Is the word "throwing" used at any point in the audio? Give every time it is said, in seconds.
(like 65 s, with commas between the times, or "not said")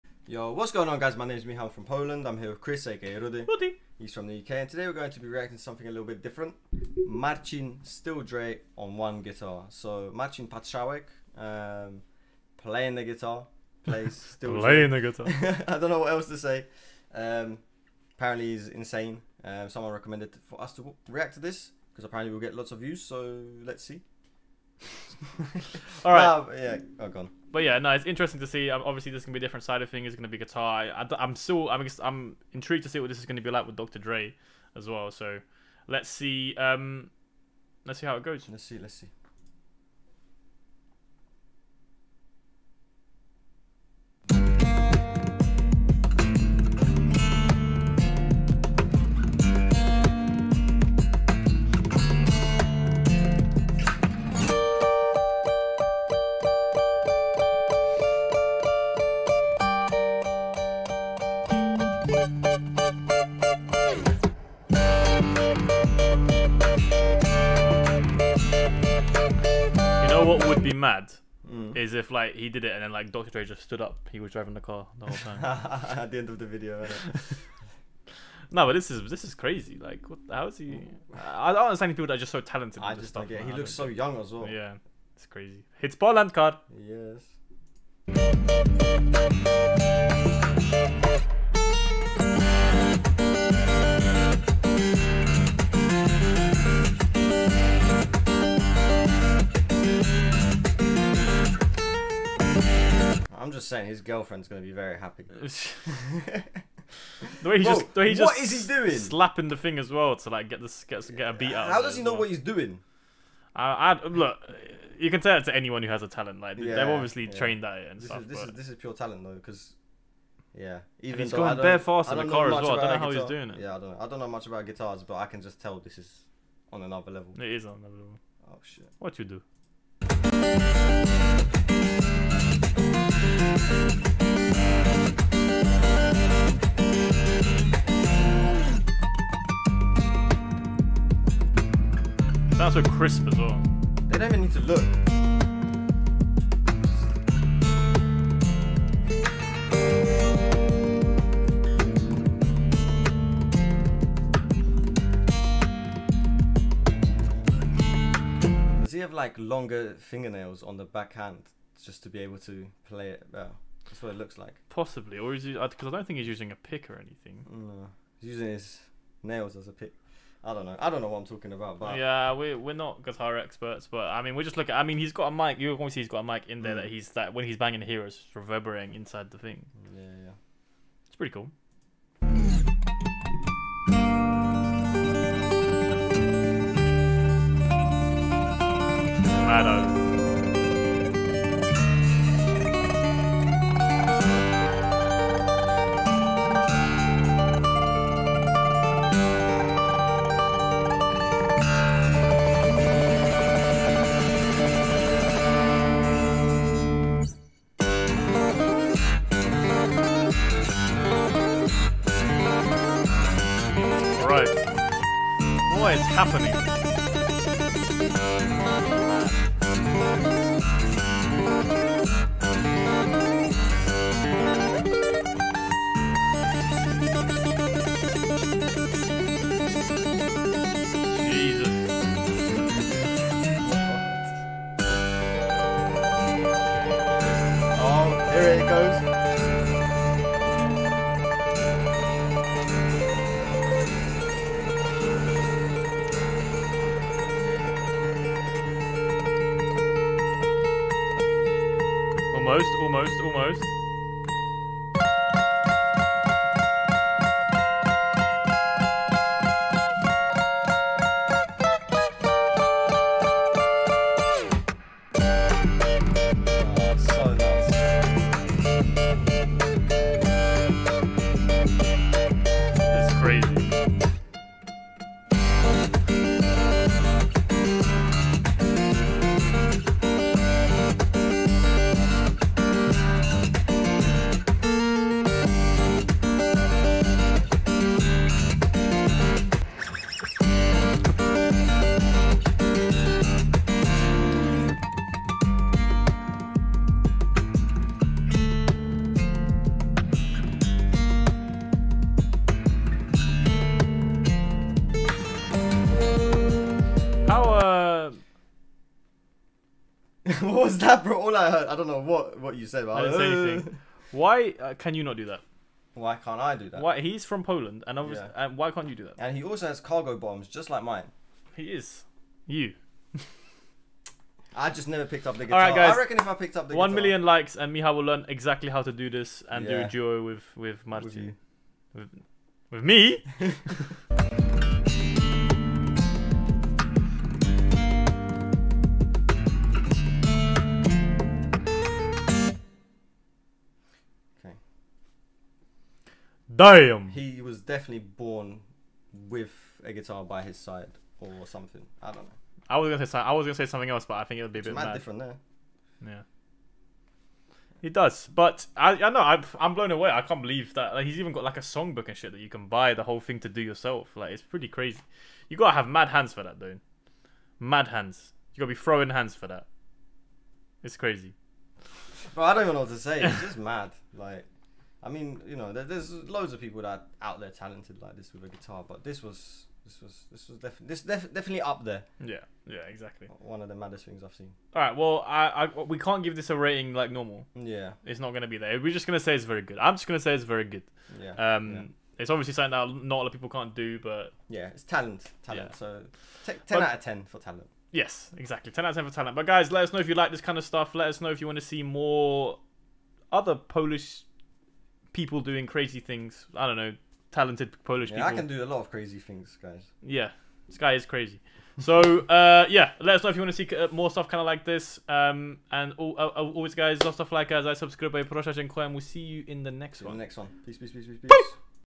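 368 s.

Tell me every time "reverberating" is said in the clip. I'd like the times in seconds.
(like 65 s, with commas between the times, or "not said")
178 s.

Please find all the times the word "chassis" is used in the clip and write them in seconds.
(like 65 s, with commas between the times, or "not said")
not said.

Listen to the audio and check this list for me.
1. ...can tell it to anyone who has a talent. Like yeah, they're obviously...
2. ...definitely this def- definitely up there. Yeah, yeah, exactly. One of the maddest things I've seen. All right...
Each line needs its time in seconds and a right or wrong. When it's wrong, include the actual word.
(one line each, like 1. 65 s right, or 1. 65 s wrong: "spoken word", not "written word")
1. 115 s right
2. 380 s right.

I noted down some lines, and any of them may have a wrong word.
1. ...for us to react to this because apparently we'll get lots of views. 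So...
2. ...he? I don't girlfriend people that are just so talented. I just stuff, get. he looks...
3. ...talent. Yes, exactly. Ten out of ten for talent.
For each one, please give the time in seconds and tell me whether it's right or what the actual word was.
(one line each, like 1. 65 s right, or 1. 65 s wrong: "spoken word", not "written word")
1. 20 s right
2. 80 s wrong: "understand", not "girlfriend"
3. 397 s right.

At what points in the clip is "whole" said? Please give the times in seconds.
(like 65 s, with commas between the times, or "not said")
75 s, 363 s.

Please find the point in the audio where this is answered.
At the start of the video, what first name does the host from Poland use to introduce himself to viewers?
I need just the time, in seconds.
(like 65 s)
1 s.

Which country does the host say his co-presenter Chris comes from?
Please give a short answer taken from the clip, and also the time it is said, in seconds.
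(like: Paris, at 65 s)
UK, at 4 s.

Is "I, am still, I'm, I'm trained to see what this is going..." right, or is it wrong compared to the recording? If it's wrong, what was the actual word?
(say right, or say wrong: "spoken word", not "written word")
wrong: "intrigued", not "trained".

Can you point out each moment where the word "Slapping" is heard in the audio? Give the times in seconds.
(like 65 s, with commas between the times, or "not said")
108 s.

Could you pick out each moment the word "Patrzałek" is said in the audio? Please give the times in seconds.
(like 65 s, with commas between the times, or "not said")
10 s.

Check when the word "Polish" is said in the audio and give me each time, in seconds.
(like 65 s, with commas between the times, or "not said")
403 s, 407 s.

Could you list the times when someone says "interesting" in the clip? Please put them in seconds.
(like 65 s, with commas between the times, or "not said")
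28 s.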